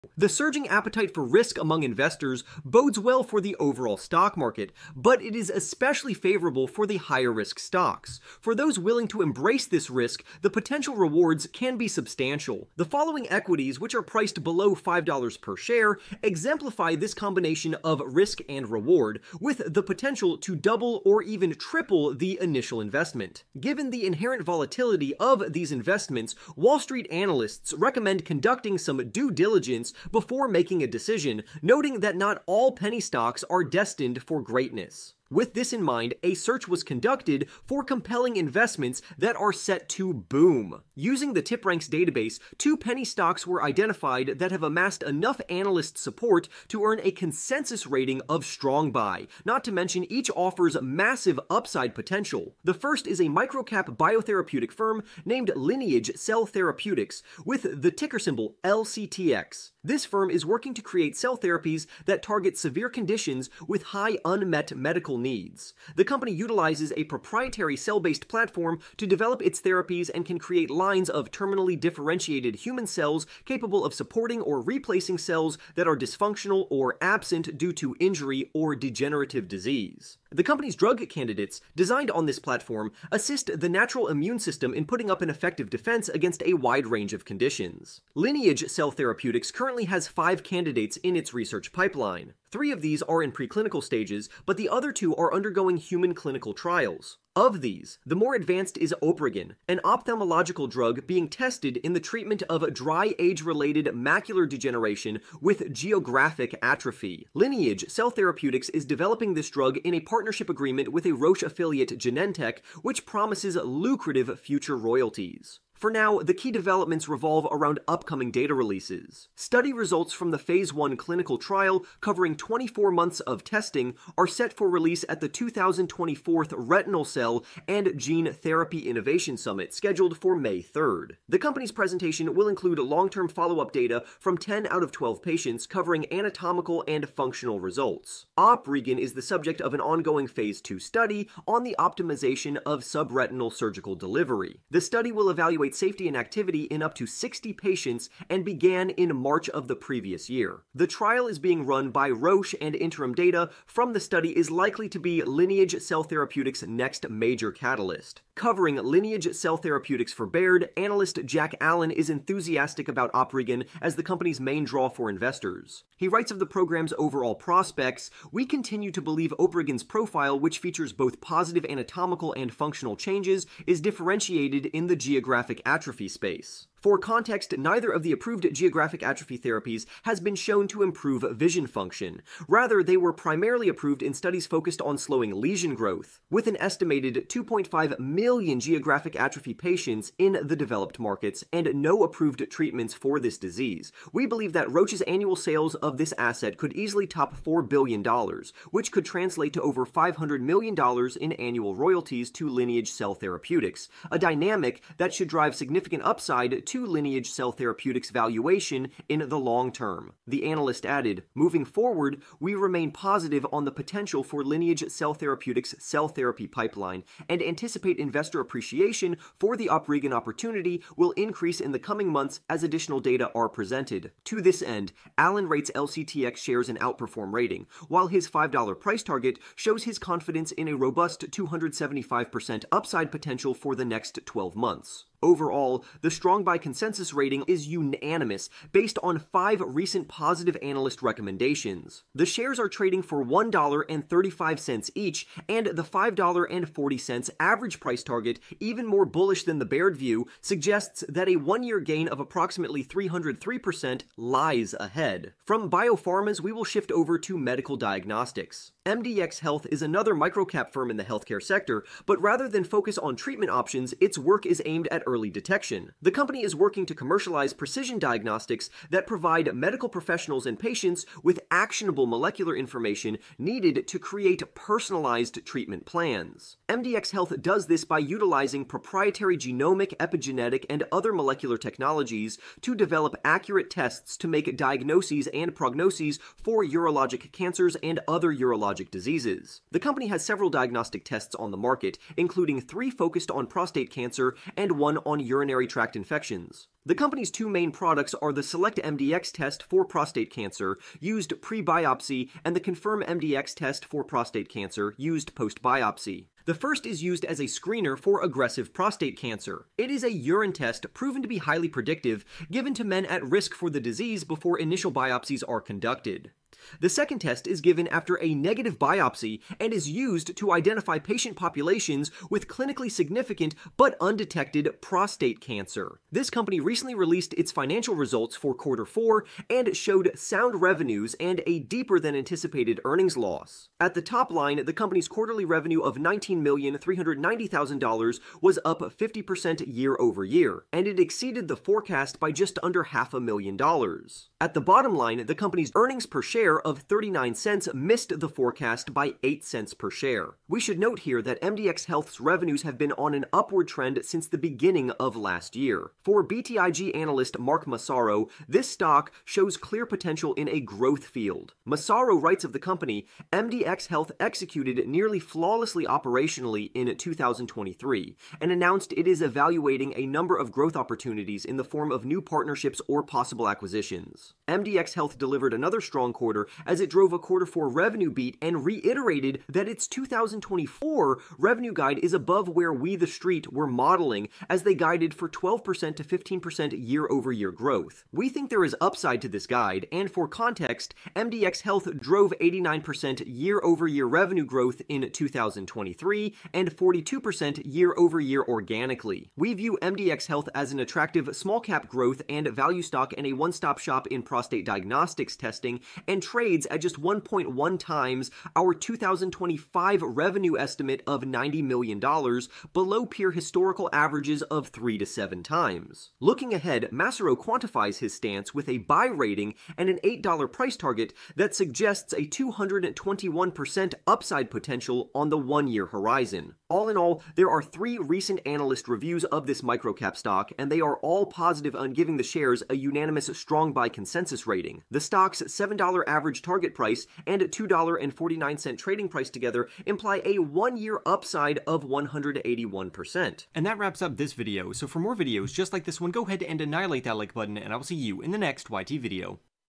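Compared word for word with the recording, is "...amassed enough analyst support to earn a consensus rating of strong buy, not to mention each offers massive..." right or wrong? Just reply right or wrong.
right.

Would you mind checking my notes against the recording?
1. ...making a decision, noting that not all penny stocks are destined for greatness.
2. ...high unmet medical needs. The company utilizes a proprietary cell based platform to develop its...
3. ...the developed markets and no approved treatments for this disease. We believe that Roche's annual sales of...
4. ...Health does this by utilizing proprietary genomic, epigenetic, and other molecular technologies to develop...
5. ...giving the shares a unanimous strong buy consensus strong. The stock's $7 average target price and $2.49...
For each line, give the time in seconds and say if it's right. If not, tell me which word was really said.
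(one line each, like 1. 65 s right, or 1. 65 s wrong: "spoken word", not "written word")
1. 30 s right
2. 63 s right
3. 190 s right
4. 277 s right
5. 431 s wrong: "rating", not "strong".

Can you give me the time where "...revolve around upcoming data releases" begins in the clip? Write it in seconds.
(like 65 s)
117 s.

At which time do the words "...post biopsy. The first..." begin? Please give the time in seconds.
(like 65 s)
305 s.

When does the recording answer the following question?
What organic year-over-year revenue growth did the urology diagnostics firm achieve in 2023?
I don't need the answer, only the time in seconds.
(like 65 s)
396 s.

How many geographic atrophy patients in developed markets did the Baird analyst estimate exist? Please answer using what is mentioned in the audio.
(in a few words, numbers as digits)
2.5 million.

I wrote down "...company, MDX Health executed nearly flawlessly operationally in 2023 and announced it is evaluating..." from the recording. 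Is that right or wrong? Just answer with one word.
right.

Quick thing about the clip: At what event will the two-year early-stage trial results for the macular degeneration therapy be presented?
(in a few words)
Retinal Cell and Gene Therapy Innovation Summit.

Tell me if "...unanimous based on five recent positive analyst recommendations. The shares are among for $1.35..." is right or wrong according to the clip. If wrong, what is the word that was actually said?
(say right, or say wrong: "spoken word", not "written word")
wrong: "trading", not "among".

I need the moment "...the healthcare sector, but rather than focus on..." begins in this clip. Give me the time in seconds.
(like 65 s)
260 s.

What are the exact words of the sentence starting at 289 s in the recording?
The company has several diagnostic tests on the market, including three focused on prostate cancer and one on urinary tract infections.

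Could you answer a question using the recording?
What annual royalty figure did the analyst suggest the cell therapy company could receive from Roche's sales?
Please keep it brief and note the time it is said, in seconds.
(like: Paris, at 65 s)
over $500 million, at 199 s.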